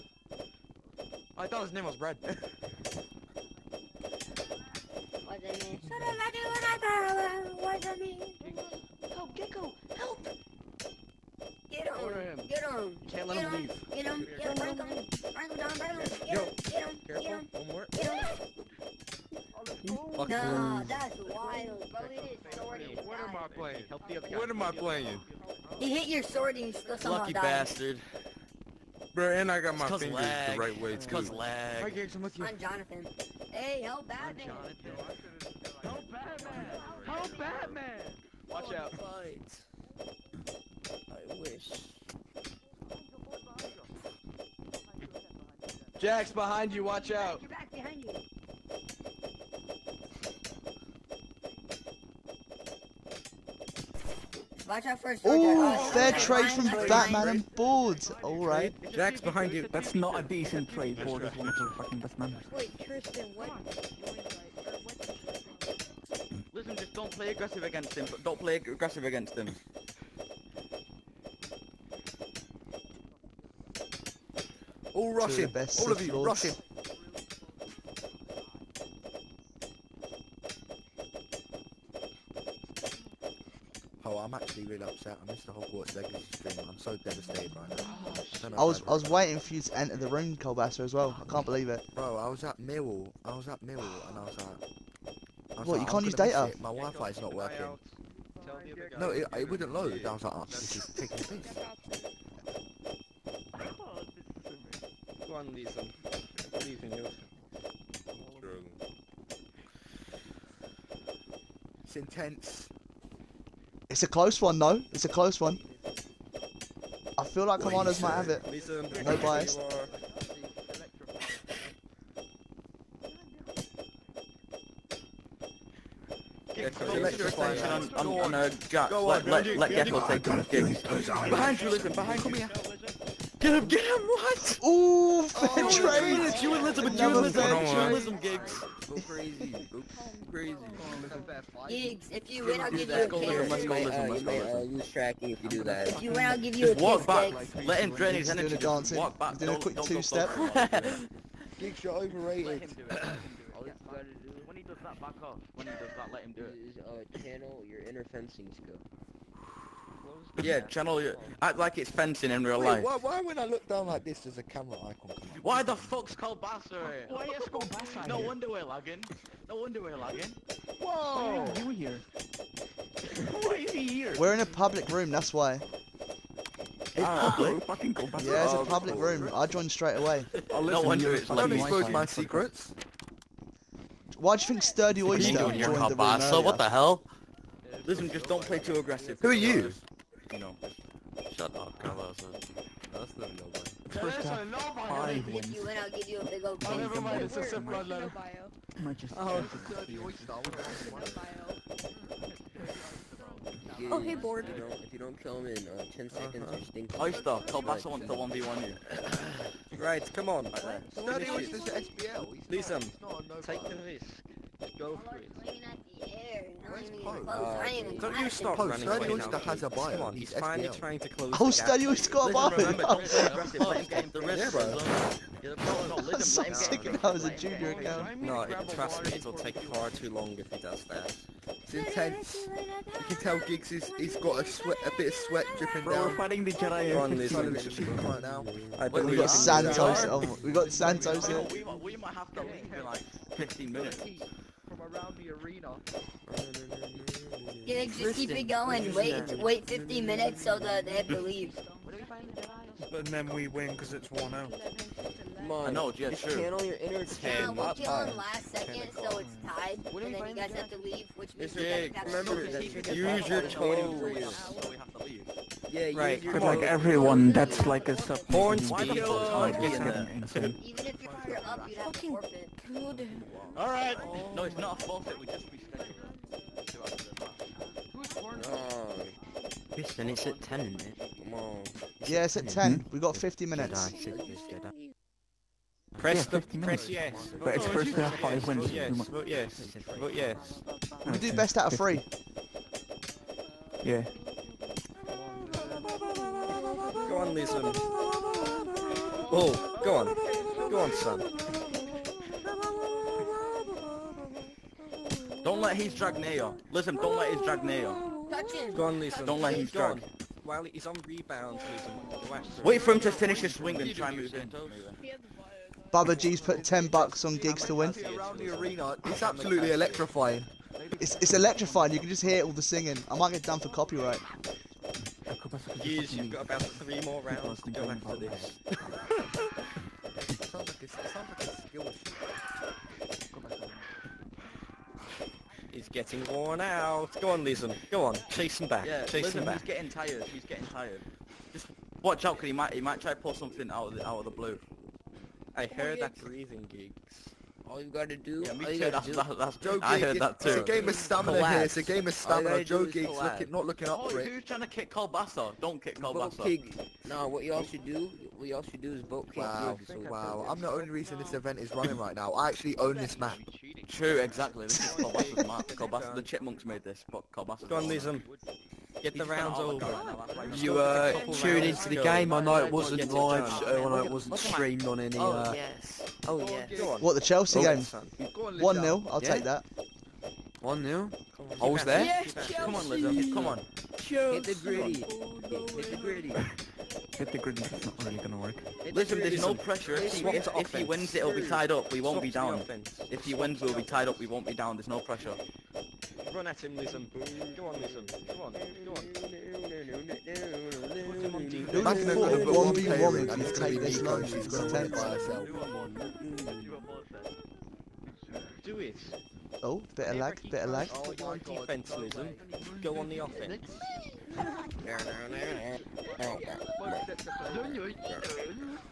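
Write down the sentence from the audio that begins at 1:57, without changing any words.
I feel like commanders might have it.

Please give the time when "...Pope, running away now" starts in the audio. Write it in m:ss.
3:38.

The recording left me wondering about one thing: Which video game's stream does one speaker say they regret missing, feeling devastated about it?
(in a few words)
Hogwarts Legacy.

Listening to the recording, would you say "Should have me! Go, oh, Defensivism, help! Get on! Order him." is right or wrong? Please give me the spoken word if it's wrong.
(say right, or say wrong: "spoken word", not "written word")
wrong: "Gecko", not "Defensivism".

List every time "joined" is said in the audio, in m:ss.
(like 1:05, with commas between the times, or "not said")
2:59, 3:05.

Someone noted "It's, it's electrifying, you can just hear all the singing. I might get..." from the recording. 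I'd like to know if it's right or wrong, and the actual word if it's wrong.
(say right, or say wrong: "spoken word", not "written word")
right.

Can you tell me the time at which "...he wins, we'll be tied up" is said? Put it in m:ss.
6:33.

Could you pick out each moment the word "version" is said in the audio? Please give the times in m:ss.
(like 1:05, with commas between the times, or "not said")
not said.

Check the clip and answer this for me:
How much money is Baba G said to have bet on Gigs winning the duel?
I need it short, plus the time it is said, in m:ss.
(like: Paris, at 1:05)
10 bucks, at 5:16.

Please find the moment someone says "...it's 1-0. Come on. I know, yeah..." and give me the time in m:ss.
4:13.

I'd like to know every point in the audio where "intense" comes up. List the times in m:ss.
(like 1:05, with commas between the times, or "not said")
1:51, 3:51.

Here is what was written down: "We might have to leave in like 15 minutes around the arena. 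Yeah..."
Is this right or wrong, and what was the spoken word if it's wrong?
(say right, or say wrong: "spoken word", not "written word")
right.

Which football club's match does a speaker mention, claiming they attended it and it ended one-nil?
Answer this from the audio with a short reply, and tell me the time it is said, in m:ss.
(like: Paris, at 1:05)
Chelsea, at 6:17.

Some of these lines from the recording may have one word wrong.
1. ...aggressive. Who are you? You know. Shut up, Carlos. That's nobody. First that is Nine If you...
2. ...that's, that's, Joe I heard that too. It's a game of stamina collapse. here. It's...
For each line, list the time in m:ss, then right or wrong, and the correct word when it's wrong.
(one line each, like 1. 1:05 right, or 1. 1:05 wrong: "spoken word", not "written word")
1. 3:08 wrong: "Five", not "Nine"
2. 5:49 right.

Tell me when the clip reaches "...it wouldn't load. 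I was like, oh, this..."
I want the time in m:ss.
1:39.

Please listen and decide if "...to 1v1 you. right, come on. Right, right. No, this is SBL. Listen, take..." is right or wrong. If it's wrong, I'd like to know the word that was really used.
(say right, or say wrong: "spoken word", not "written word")
right.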